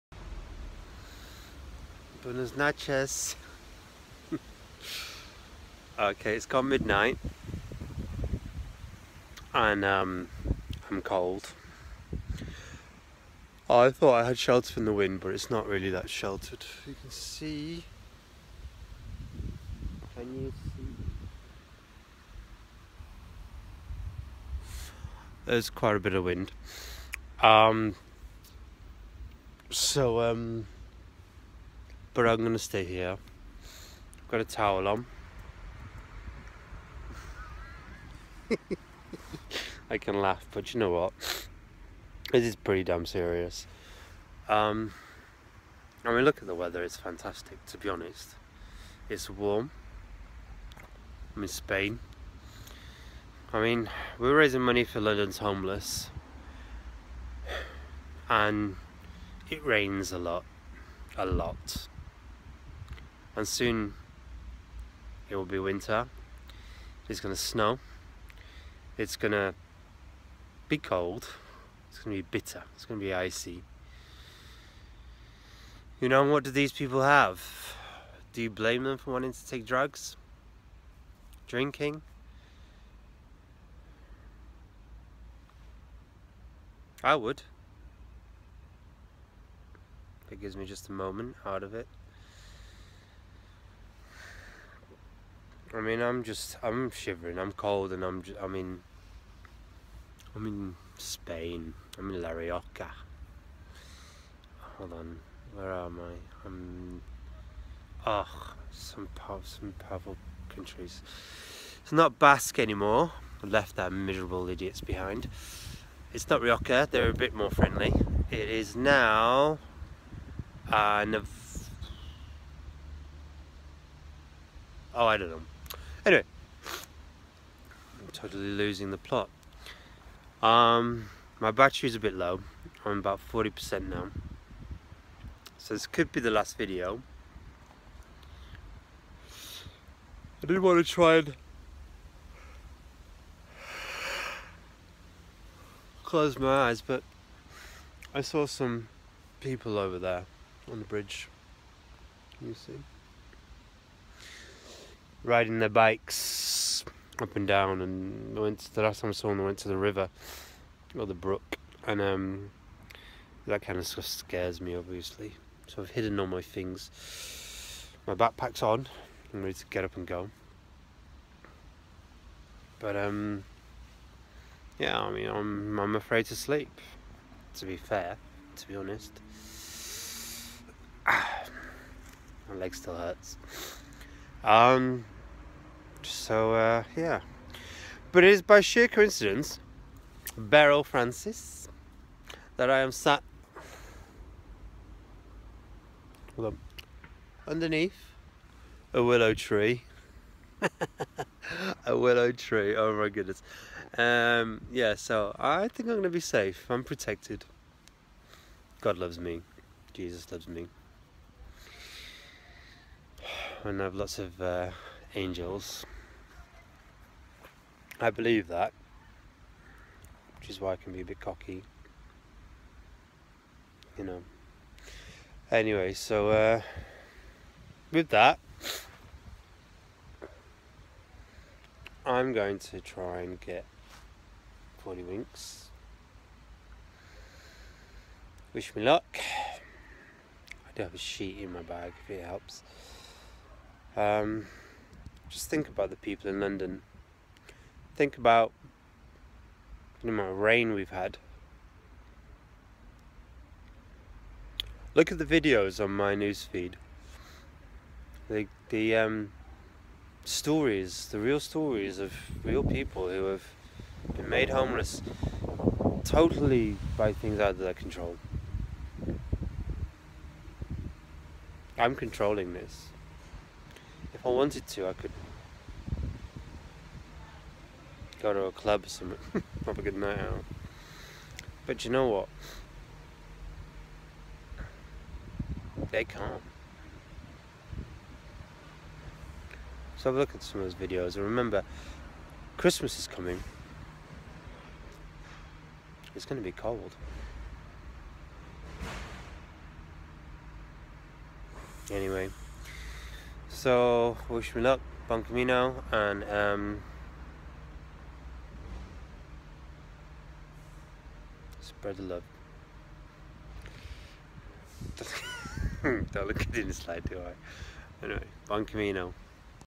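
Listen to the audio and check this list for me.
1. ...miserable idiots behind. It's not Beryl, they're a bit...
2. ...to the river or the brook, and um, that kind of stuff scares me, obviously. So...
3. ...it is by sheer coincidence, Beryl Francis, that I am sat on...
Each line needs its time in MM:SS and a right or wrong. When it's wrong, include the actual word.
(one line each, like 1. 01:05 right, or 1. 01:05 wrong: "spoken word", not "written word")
1. 01:53 wrong: "Rioja", not "Beryl"
2. 02:39 right
3. 03:08 right.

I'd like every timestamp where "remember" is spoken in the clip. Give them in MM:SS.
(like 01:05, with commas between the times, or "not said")
04:51.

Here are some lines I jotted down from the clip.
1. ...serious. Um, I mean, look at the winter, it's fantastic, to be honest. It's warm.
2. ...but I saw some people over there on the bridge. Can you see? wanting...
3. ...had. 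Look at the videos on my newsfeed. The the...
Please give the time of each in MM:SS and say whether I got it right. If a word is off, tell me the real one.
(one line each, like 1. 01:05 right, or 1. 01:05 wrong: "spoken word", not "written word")
1. 00:43 wrong: "weather", not "winter"
2. 02:26 wrong: "riding", not "wanting"
3. 04:10 right.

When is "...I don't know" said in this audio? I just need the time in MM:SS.
02:05.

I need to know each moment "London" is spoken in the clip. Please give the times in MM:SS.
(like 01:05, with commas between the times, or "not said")
00:55, 04:06.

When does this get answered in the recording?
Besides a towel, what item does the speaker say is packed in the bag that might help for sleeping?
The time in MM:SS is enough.
04:00.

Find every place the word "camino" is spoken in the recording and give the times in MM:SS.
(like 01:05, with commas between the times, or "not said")
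05:05, 05:18.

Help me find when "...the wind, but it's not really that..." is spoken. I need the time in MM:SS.
00:14.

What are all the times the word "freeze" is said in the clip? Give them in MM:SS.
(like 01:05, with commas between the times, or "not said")
not said.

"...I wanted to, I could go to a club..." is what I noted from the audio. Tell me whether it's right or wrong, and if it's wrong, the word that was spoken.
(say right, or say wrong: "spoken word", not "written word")
right.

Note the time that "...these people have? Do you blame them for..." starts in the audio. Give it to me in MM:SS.
01:16.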